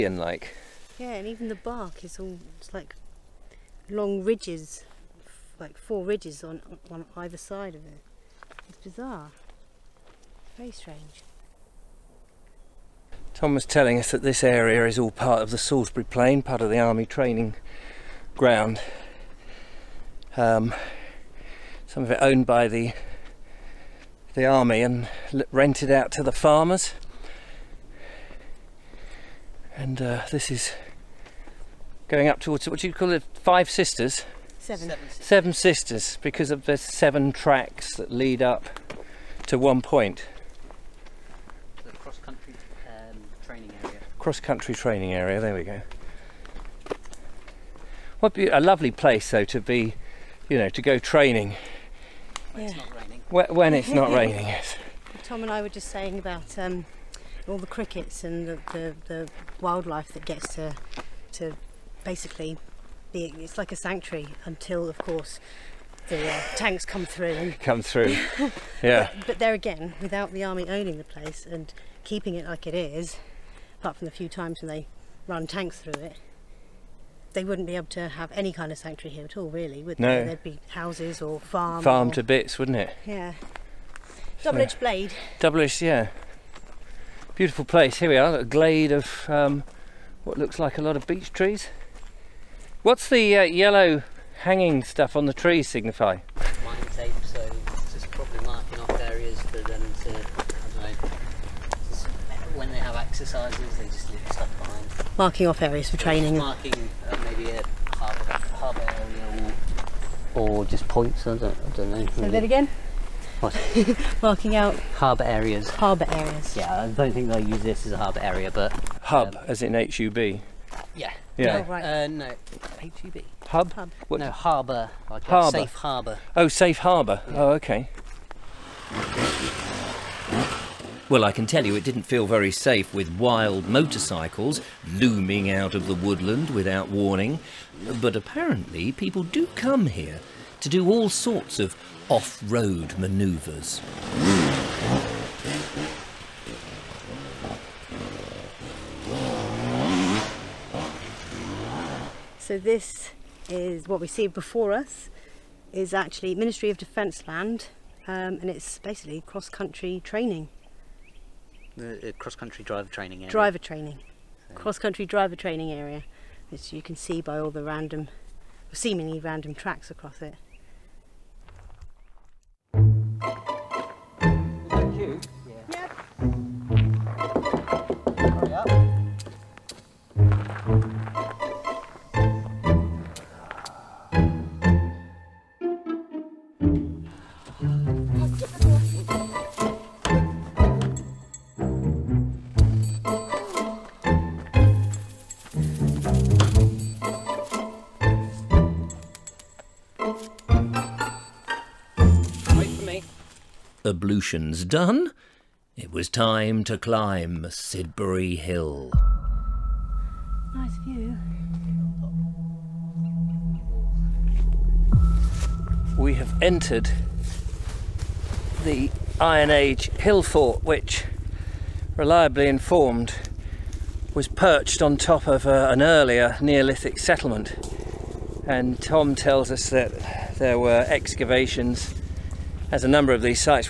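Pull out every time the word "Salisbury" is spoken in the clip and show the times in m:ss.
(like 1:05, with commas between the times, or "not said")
0:15.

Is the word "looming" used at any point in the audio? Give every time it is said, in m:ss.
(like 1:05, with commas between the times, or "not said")
2:14.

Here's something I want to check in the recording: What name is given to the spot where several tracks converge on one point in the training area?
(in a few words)
Seven Sisters.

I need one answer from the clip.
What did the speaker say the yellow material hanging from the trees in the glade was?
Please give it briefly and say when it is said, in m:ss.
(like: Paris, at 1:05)
Mine tape, at 1:36.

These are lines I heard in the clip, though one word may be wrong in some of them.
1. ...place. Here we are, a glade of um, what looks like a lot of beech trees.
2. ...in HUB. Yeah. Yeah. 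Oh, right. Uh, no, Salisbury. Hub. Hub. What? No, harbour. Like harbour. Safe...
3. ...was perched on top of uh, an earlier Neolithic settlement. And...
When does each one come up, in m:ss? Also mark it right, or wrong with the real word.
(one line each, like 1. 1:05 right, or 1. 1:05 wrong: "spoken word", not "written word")
1. 1:27 right
2. 1:59 wrong: "HUB", not "Salisbury"
3. 3:44 right.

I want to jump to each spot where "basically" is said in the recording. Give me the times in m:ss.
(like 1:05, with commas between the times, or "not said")
1:02, 2:38.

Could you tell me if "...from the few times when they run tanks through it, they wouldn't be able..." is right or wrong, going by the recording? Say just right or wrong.
right.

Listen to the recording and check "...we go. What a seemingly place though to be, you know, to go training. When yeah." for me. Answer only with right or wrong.
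wrong.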